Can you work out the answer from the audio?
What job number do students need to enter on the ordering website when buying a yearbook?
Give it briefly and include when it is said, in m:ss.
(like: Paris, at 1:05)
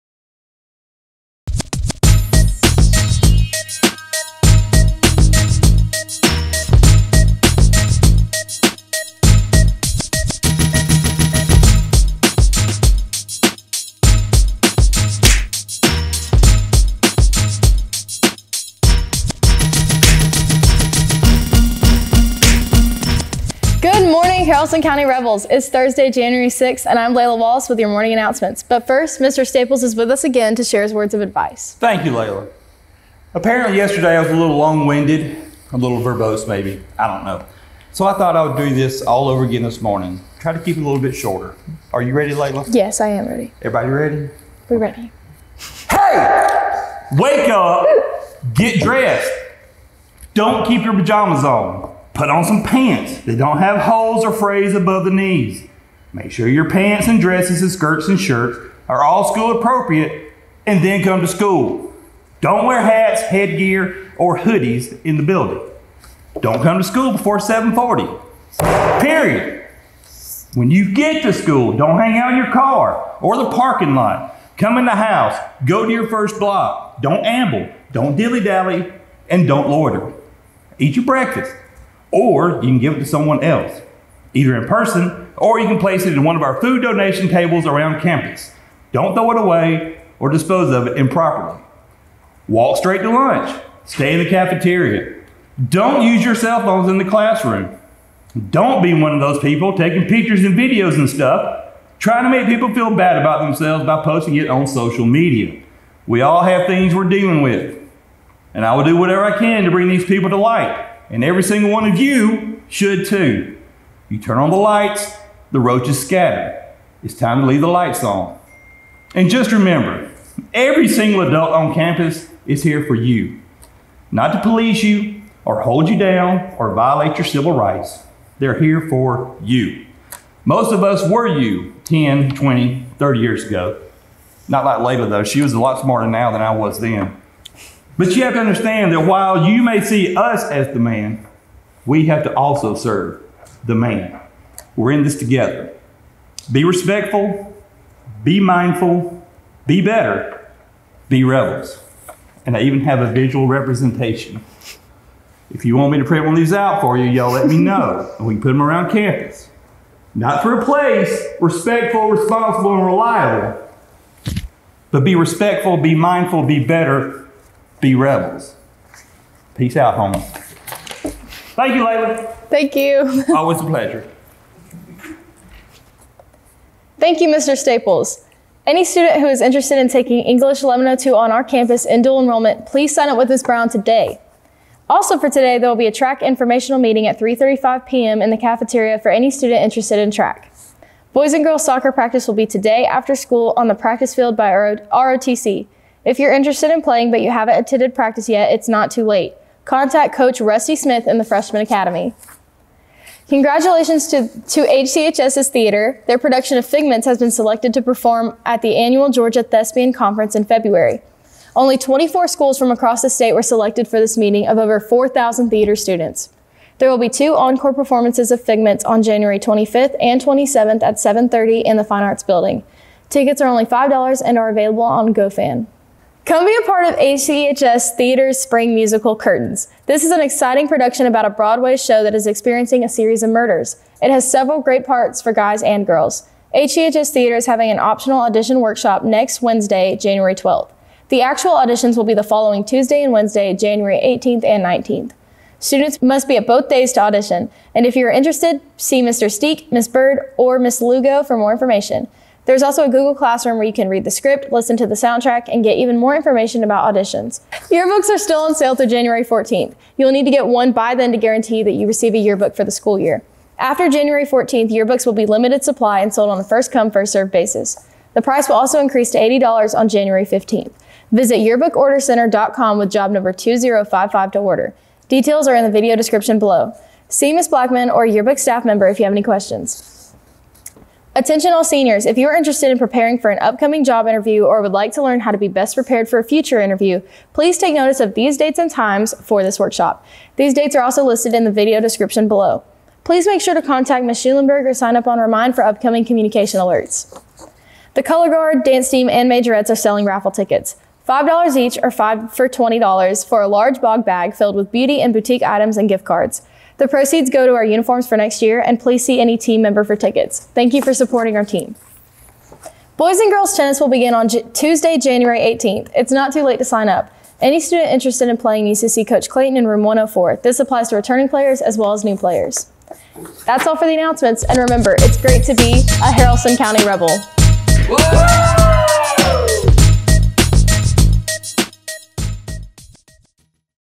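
2055, at 4:33.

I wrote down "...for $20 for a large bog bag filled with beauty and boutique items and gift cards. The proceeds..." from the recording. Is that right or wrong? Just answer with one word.
right.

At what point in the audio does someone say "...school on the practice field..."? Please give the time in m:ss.
3:13.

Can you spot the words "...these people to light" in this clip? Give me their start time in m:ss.
1:49.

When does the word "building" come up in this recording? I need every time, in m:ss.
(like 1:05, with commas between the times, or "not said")
1:05, 3:42.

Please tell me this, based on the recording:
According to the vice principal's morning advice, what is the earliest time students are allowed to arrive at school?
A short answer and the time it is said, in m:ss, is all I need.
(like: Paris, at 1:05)
7:40, at 1:07.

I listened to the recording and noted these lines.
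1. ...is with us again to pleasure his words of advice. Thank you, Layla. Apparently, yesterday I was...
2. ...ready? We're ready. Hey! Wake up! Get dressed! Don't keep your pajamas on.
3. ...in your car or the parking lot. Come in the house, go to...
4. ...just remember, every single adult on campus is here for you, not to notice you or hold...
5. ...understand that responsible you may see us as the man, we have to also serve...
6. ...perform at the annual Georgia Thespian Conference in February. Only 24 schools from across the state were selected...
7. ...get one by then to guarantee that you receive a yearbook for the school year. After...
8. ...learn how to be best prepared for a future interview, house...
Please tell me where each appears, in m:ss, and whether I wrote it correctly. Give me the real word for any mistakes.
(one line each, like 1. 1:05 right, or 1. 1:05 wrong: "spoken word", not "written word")
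1. 0:29 wrong: "share", not "pleasure"
2. 0:43 right
3. 1:12 right
4. 1:59 wrong: "police", not "notice"
5. 2:18 wrong: "while", not "responsible"
6. 3:27 right
7. 4:20 right
8. 4:45 wrong: "please", not "house".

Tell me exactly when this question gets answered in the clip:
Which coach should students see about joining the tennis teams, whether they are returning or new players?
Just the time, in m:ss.
5:19.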